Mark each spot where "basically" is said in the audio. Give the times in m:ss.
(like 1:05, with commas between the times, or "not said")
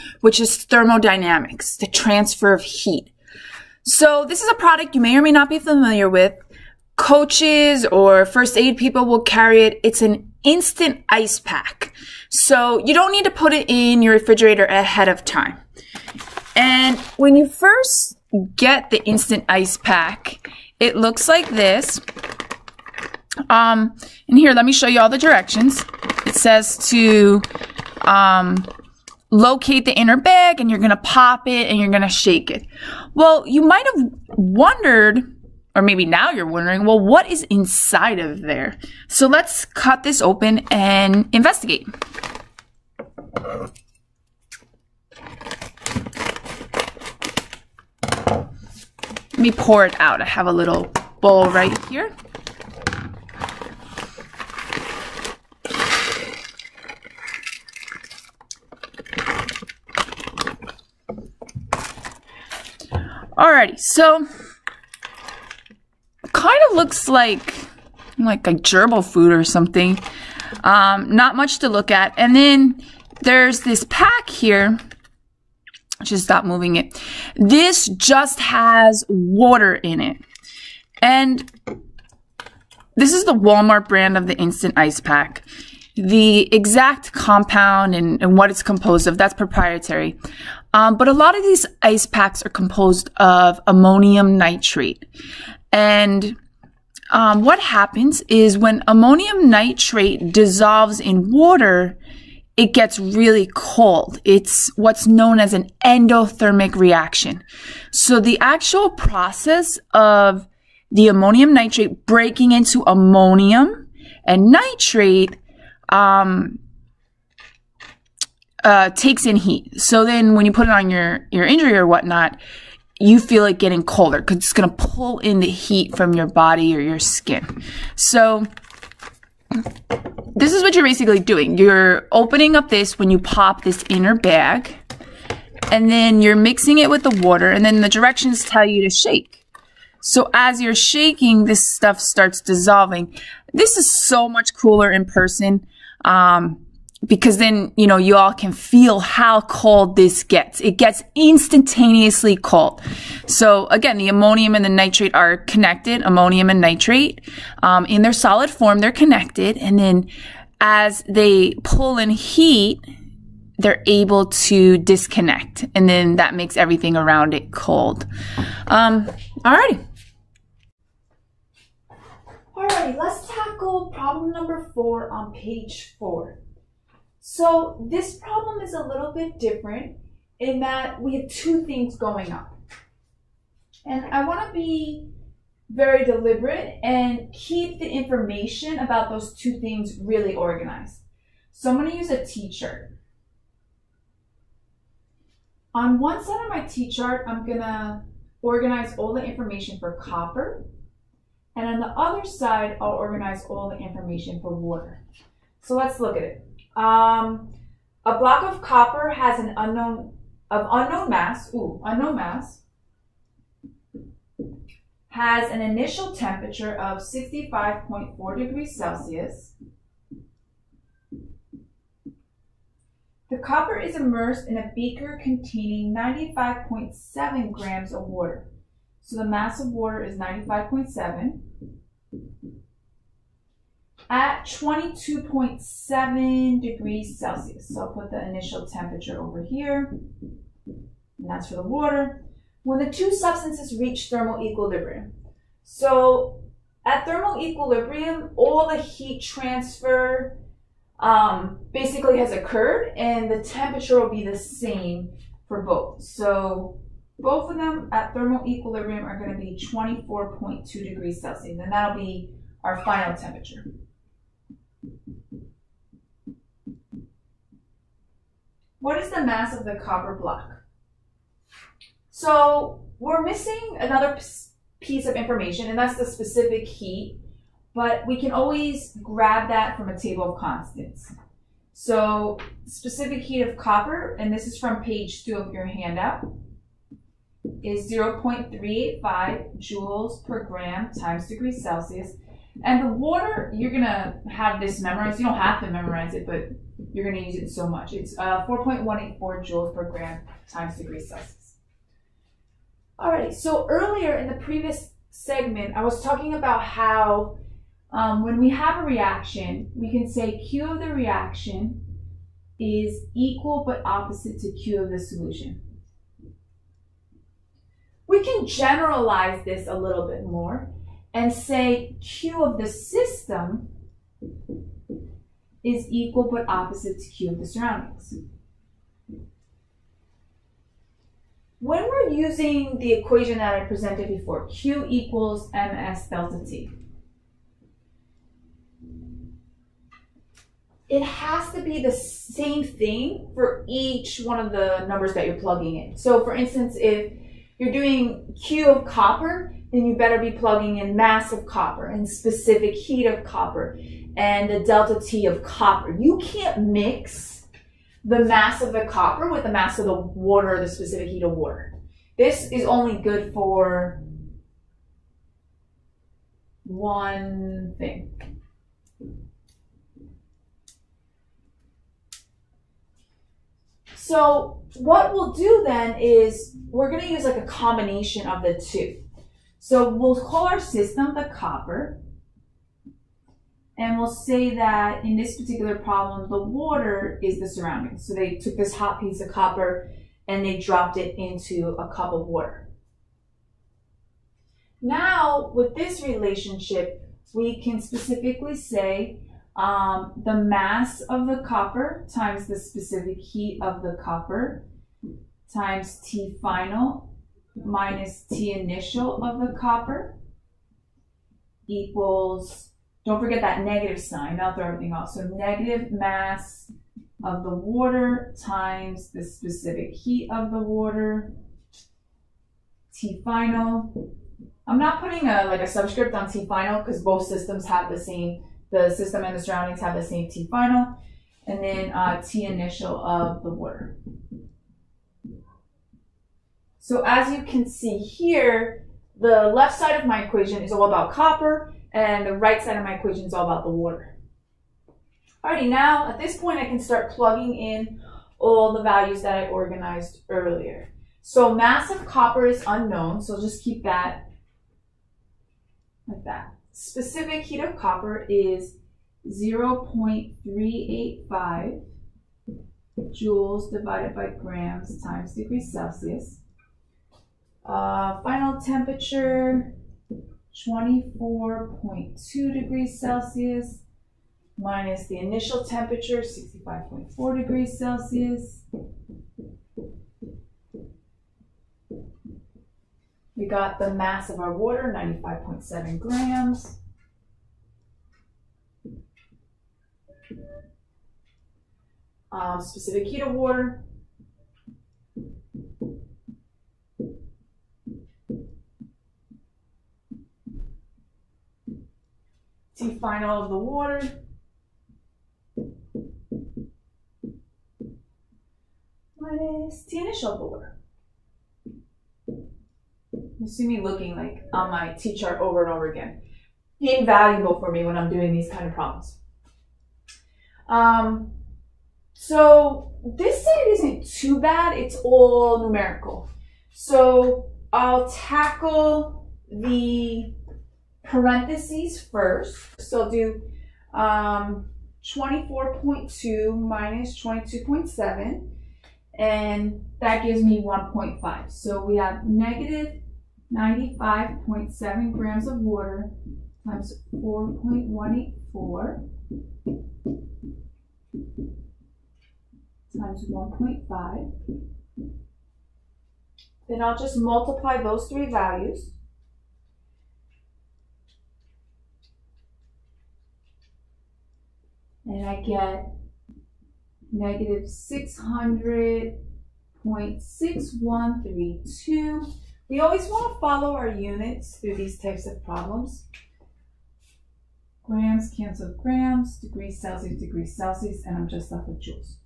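2:10, 4:11.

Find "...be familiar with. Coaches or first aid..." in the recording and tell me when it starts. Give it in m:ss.
0:05.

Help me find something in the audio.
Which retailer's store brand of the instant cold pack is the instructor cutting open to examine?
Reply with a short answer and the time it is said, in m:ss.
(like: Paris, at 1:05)
Walmart, at 1:23.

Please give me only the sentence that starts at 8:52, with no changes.
So I'll do um, 24.2 minus 22.7, and that gives me 1.5.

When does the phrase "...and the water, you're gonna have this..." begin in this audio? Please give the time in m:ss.
4:52.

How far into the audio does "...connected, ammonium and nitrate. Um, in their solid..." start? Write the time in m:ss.
2:35.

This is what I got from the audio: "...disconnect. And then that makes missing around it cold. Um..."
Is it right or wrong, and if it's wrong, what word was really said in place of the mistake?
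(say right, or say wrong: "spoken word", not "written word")
wrong: "everything", not "missing".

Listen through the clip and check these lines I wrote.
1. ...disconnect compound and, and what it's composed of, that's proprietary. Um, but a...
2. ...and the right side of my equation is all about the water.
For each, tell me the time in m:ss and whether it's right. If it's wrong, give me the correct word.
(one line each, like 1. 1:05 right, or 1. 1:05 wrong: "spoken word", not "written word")
1. 1:26 wrong: "exact", not "disconnect"
2. 7:21 right.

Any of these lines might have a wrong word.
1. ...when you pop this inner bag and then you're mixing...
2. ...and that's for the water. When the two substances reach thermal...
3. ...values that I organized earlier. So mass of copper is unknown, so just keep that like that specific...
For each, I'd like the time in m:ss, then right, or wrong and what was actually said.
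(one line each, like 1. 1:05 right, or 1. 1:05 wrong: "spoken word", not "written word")
1. 2:12 right
2. 4:00 right
3. 7:28 right.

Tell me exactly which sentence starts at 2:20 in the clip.
So as you're shaking, this stuff starts dissolving.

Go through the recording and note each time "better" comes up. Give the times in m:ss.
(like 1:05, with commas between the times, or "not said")
5:49.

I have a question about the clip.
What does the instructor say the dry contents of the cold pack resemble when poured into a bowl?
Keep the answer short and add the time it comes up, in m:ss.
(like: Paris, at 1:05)
gerbil food, at 1:08.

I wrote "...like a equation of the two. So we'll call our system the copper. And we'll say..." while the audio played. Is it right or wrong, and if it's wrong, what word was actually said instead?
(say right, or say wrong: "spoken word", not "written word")
wrong: "combination", not "equation".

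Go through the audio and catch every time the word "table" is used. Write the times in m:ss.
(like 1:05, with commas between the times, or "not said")
4:39.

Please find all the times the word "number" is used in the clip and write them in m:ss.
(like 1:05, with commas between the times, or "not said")
2:54, 5:44.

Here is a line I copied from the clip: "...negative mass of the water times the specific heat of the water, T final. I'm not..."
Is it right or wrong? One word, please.
right.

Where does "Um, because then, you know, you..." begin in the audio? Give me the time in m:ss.
2:26.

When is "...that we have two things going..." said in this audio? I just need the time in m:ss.
3:00.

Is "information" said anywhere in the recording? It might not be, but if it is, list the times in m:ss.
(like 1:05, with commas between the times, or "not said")
3:07, 3:19, 3:23, 4:35.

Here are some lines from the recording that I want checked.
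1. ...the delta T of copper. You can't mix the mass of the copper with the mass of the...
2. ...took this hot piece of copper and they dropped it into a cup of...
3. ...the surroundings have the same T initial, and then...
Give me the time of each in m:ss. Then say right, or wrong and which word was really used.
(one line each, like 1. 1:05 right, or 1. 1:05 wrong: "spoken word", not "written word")
1. 5:54 right
2. 6:28 right
3. 7:09 wrong: "final", not "initial".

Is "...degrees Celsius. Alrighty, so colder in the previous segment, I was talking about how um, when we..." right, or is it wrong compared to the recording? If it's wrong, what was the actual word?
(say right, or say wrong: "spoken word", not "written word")
wrong: "earlier", not "colder".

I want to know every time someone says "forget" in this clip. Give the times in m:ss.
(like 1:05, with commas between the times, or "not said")
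6:53.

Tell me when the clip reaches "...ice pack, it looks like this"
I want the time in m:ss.
0:19.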